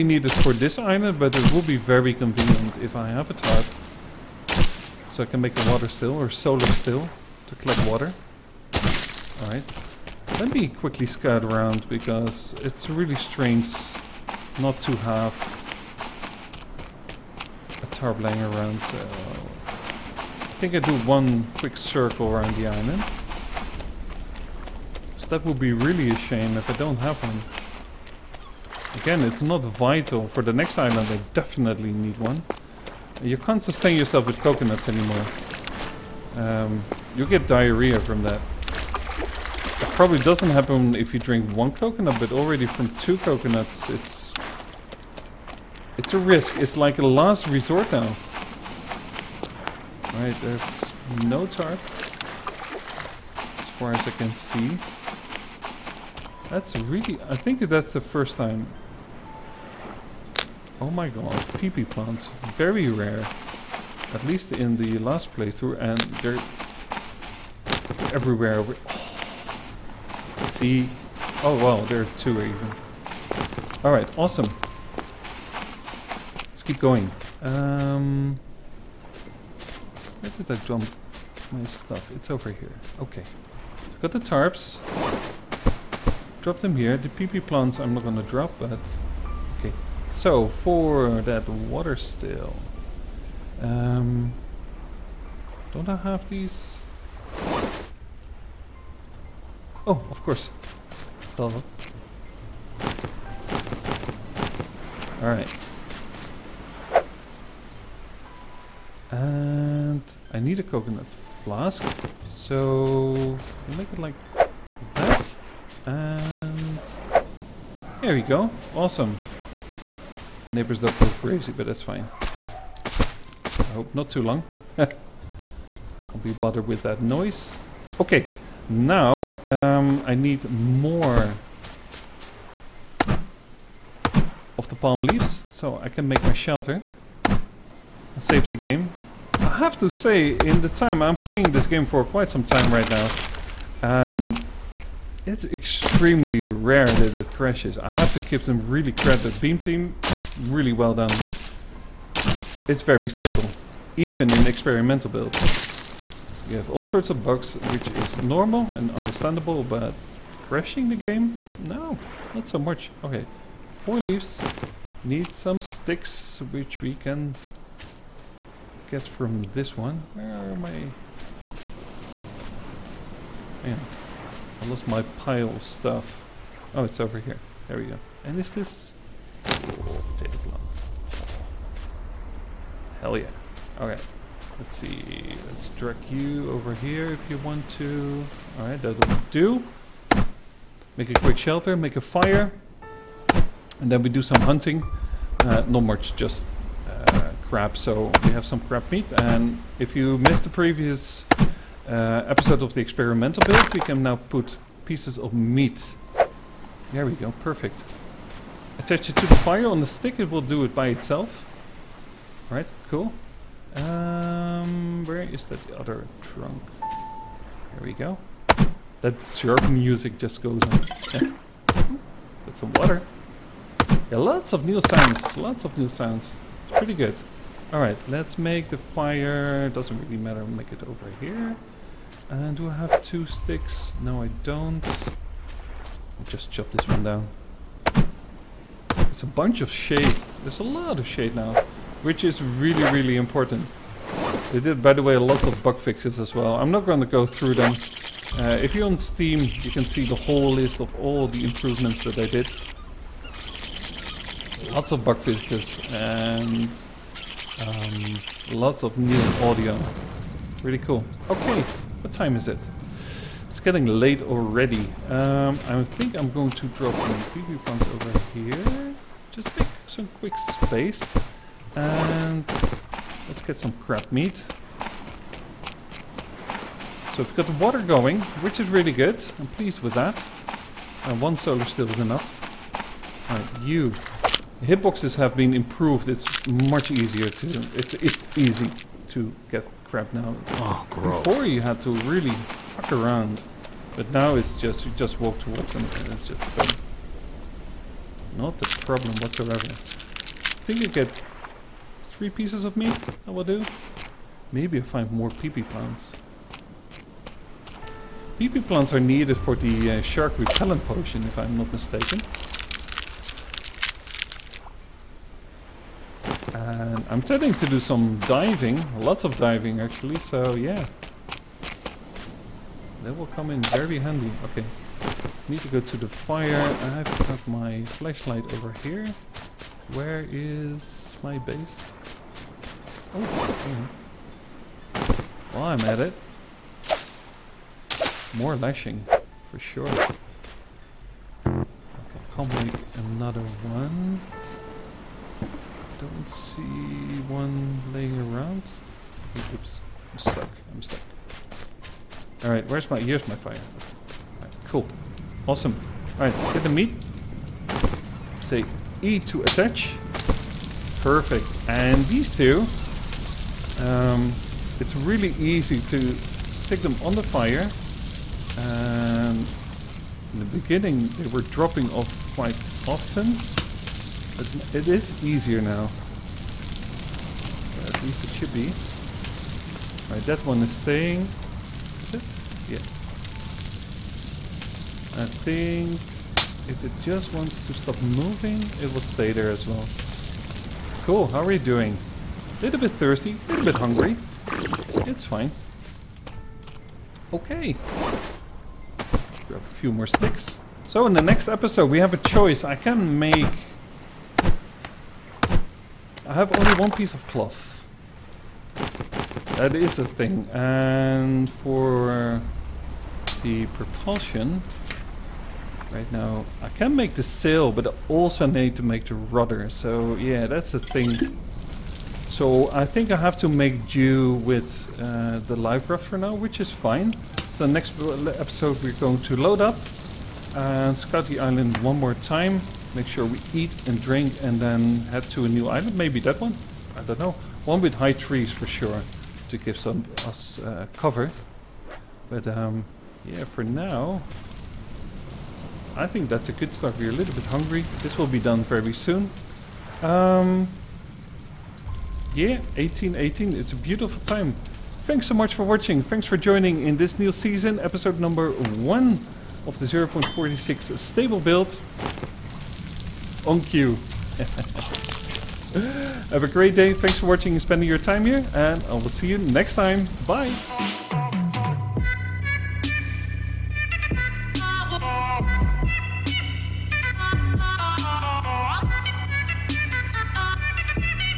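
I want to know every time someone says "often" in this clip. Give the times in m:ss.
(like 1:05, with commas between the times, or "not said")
6:12.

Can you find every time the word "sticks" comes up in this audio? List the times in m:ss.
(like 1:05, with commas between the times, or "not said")
2:45, 3:29, 3:53, 6:06, 6:40.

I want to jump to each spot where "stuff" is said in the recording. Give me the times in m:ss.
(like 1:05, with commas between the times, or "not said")
1:21, 2:55.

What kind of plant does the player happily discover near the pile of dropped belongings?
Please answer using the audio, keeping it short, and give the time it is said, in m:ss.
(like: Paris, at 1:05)
Potato plant, at 2:59.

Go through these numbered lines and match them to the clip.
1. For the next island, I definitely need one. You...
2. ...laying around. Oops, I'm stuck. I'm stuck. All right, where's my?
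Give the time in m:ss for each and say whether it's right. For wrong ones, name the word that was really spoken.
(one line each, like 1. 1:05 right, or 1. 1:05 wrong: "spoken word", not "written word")
1. 0:30 right
2. 5:47 right.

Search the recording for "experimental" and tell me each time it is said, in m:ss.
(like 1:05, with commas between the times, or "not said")
2:34, 3:22.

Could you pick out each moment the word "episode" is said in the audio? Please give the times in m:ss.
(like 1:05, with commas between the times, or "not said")
3:22, 6:41, 7:08, 7:37.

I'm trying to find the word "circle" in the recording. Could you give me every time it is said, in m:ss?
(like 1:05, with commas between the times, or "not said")
0:21.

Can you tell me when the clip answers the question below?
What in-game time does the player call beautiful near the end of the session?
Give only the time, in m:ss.
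7:32.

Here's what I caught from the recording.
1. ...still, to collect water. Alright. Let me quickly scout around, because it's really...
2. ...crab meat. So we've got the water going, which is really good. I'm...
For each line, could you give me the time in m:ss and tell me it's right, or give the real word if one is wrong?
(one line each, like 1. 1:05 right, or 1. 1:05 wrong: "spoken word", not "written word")
1. 0:06 right
2. 4:33 right.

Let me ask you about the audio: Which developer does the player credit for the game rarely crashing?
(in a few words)
Beam Team.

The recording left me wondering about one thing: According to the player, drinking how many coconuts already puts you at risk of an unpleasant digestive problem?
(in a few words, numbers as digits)
2.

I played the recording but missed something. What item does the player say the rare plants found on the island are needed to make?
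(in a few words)
Shark repellent potion.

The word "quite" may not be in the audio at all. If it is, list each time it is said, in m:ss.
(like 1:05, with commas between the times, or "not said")
2:22, 6:12.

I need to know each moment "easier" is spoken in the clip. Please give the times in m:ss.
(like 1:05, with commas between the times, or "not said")
4:46, 6:15.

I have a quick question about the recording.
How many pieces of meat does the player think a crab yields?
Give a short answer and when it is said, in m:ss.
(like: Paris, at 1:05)
3, at 5:02.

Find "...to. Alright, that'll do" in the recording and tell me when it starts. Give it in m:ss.
3:07.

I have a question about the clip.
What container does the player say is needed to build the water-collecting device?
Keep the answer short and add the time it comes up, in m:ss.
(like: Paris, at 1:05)
Coconut flask, at 1:50.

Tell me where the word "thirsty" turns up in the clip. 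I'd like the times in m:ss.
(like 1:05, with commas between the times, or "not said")
6:32.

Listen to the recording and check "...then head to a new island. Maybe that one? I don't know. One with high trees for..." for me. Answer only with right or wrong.
right.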